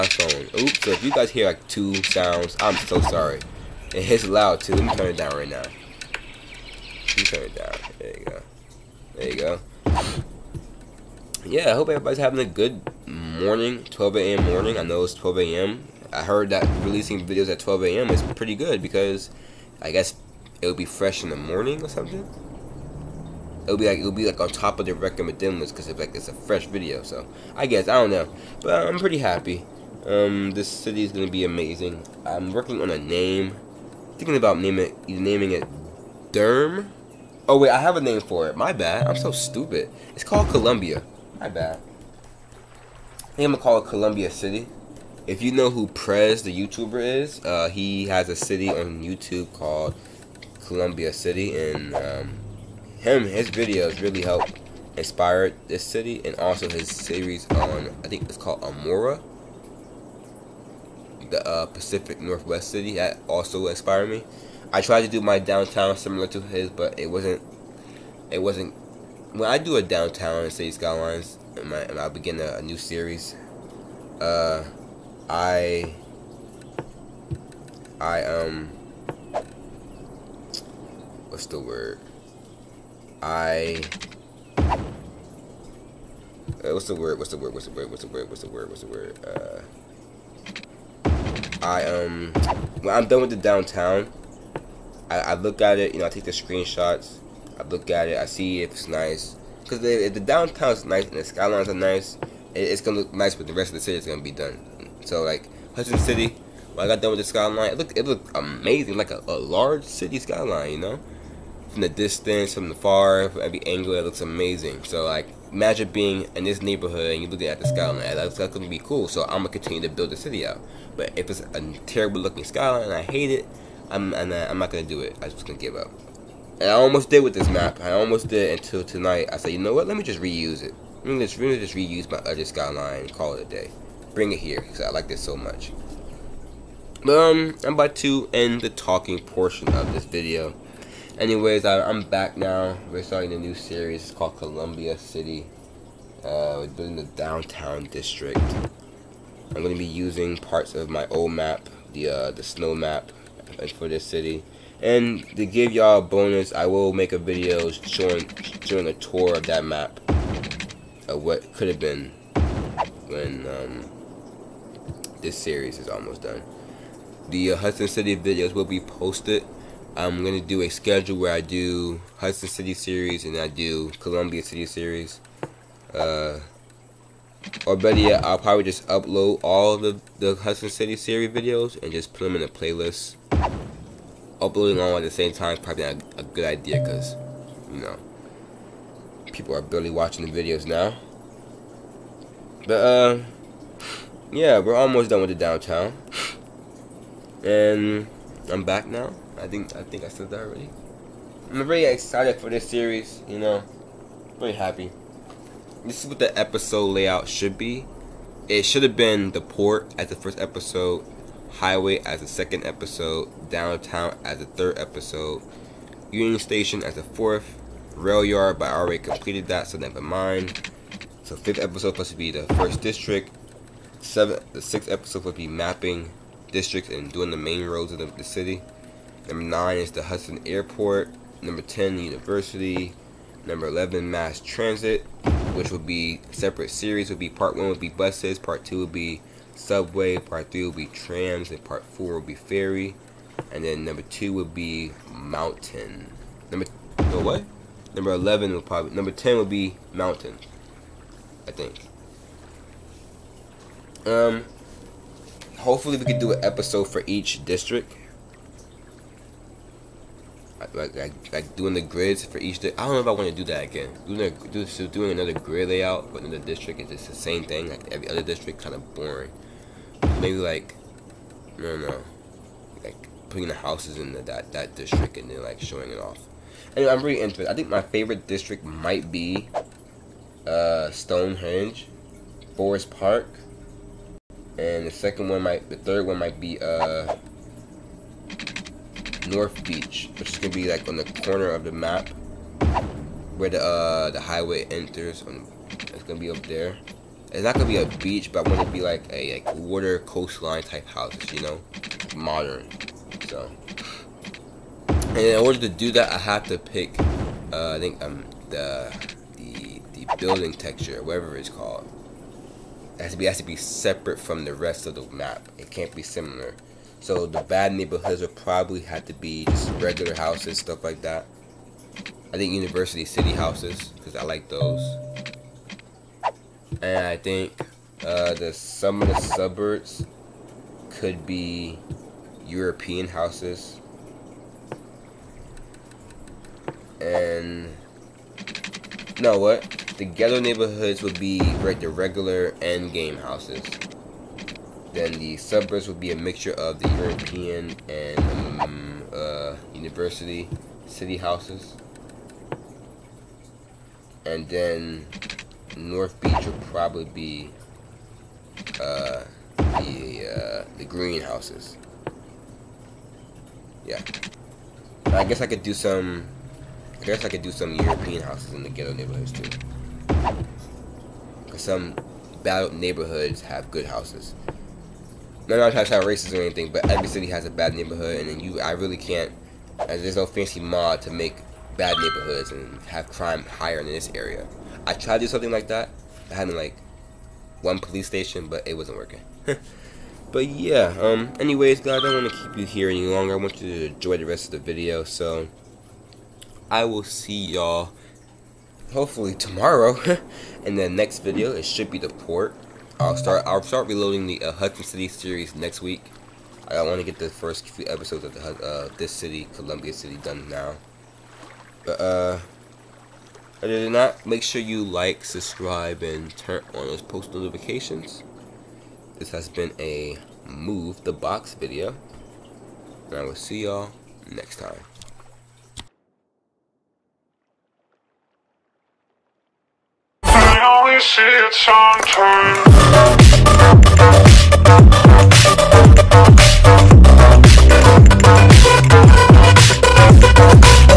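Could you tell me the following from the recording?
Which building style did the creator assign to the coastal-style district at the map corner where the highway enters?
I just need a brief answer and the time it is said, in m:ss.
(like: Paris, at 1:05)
greenhouses, at 6:00.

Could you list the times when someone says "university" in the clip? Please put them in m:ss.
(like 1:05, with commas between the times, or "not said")
3:52, 5:22, 5:49.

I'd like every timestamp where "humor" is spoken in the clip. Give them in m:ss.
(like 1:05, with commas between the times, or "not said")
not said.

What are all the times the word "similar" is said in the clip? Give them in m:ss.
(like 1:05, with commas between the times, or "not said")
1:05, 5:16.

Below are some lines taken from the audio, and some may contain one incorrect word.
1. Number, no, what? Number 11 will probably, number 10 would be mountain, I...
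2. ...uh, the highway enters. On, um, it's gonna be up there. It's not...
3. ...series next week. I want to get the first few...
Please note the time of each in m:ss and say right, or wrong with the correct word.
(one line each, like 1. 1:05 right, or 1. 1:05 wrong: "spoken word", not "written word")
1. 4:06 right
2. 4:53 right
3. 6:45 right.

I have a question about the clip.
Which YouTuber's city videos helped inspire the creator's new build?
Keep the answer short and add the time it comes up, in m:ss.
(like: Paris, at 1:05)
Prez, at 0:45.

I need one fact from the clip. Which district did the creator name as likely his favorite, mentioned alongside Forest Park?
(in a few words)
Stonehenge.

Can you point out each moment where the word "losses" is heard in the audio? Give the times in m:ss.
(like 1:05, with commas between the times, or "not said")
not said.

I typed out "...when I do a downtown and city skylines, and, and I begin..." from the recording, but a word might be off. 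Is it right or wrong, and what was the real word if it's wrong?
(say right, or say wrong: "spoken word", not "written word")
right.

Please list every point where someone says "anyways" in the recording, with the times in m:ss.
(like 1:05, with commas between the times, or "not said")
2:21, 4:36, 6:31.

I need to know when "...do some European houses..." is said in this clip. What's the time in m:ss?
6:07.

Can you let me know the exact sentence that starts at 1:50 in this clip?
You know, from the distance, from the far, from every angle, it looks amazing.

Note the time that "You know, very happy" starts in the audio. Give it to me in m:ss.
3:23.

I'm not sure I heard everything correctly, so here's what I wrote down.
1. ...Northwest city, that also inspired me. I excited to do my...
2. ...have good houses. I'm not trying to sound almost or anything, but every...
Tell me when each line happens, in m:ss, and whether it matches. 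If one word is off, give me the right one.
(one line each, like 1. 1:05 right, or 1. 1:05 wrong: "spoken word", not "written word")
1. 1:02 wrong: "tried", not "excited"
2. 6:13 wrong: "racist", not "almost".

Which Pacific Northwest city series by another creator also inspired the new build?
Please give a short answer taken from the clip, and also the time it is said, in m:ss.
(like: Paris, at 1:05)
Amora, at 0:58.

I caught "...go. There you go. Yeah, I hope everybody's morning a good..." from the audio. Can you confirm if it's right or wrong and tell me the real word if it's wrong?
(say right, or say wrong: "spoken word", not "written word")
wrong: "having", not "morning".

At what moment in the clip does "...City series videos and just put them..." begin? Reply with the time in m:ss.
3:00.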